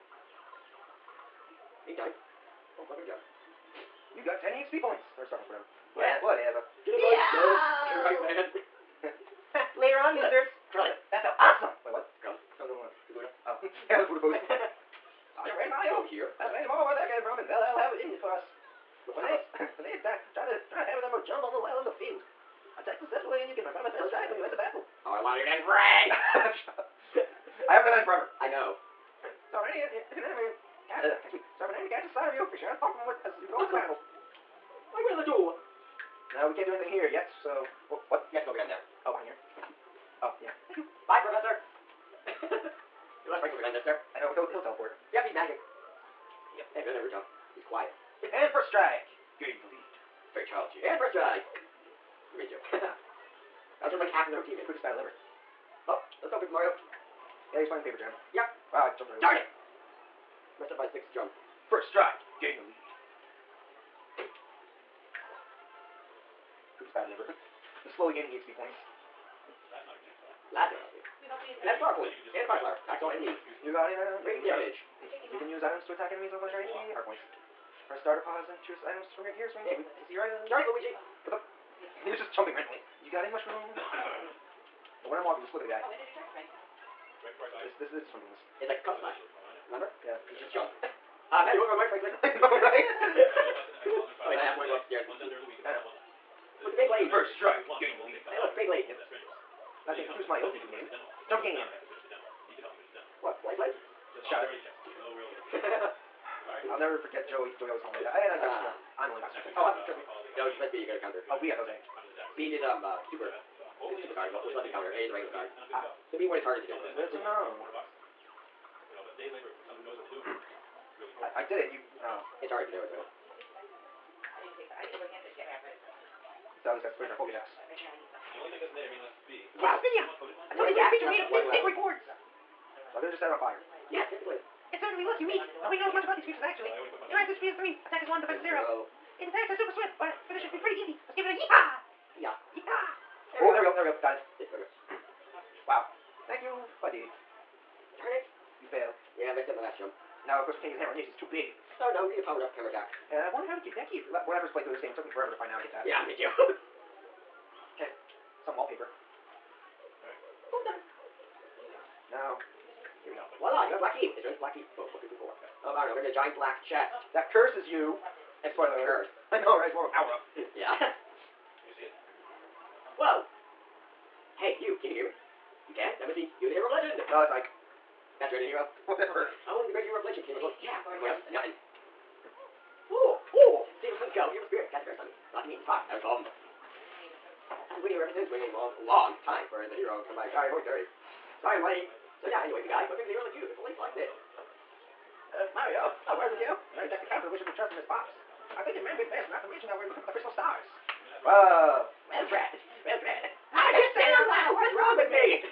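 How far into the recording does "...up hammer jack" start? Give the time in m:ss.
2:32.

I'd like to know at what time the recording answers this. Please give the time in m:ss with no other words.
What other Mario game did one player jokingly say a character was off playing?
0:57.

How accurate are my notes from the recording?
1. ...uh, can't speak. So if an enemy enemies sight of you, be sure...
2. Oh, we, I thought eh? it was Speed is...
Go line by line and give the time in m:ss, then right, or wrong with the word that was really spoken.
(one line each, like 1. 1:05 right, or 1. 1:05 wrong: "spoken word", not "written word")
1. 0:31 wrong: "catches", not "enemies"
2. 1:51 right.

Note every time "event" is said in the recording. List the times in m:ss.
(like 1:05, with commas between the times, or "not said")
1:56.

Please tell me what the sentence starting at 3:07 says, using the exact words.
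I've been waiting here ever since, waiting a long, long time for the hero to come by.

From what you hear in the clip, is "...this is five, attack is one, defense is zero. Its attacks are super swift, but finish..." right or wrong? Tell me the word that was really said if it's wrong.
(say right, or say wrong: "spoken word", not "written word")
wrong: "three", not "five".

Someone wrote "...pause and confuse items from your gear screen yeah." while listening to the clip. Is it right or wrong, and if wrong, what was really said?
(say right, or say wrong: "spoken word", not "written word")
wrong: "choose", not "confuse".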